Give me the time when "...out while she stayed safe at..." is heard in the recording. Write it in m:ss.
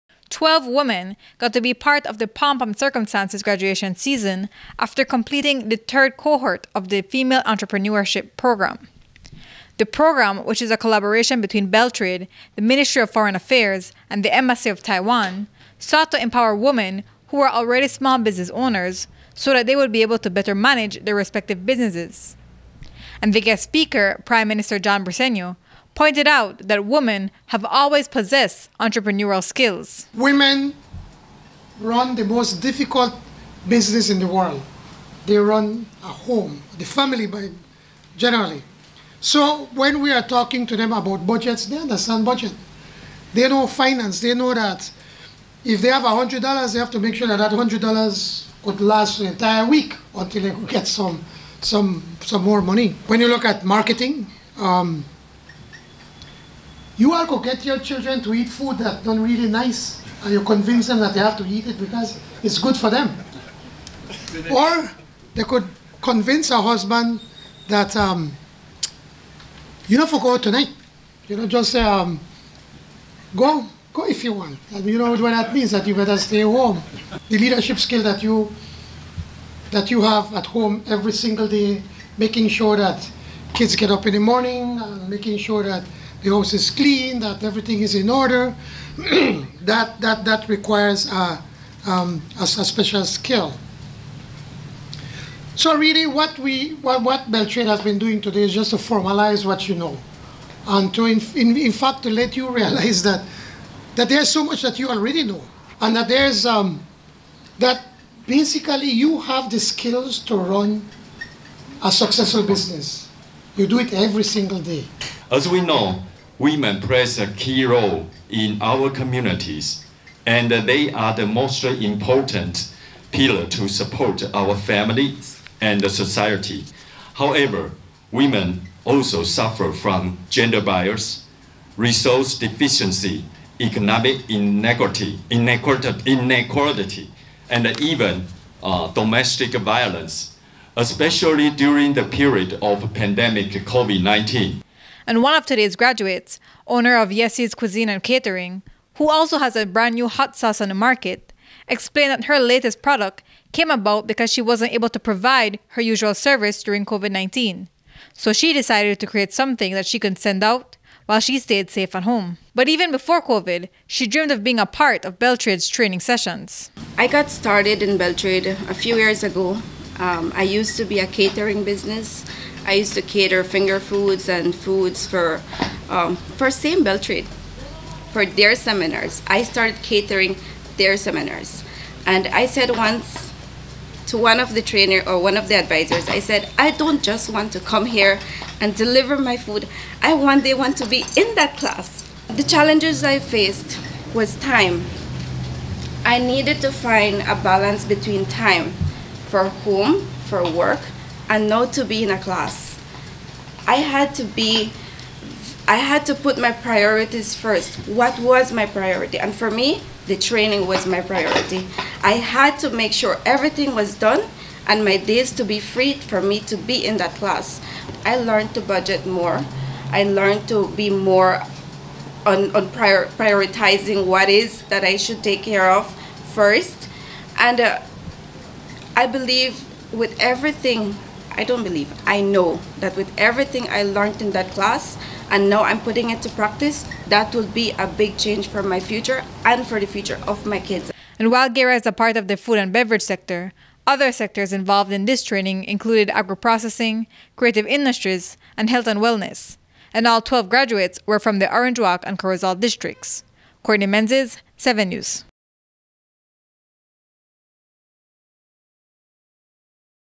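2:40.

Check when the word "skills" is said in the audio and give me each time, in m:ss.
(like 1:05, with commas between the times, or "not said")
0:29, 1:17, 1:33, 1:49.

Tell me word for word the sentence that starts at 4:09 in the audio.
And all 12 graduates were from the Orange Walk and Corozal districts.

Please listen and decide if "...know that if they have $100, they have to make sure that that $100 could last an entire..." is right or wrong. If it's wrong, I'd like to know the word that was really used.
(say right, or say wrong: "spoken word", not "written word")
right.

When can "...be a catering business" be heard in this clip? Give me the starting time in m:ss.
2:50.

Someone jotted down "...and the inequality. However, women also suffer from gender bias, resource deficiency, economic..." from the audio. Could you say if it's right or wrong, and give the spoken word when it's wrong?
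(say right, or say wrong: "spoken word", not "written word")
wrong: "society", not "inequality".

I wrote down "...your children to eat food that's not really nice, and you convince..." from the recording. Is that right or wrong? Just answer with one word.
right.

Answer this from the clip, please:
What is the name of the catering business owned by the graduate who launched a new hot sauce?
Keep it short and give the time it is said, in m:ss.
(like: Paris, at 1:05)
Yessi's Cuisine and Catering, at 2:27.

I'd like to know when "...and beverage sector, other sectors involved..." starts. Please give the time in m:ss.
4:02.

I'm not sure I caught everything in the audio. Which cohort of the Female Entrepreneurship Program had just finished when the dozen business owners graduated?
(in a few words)
third.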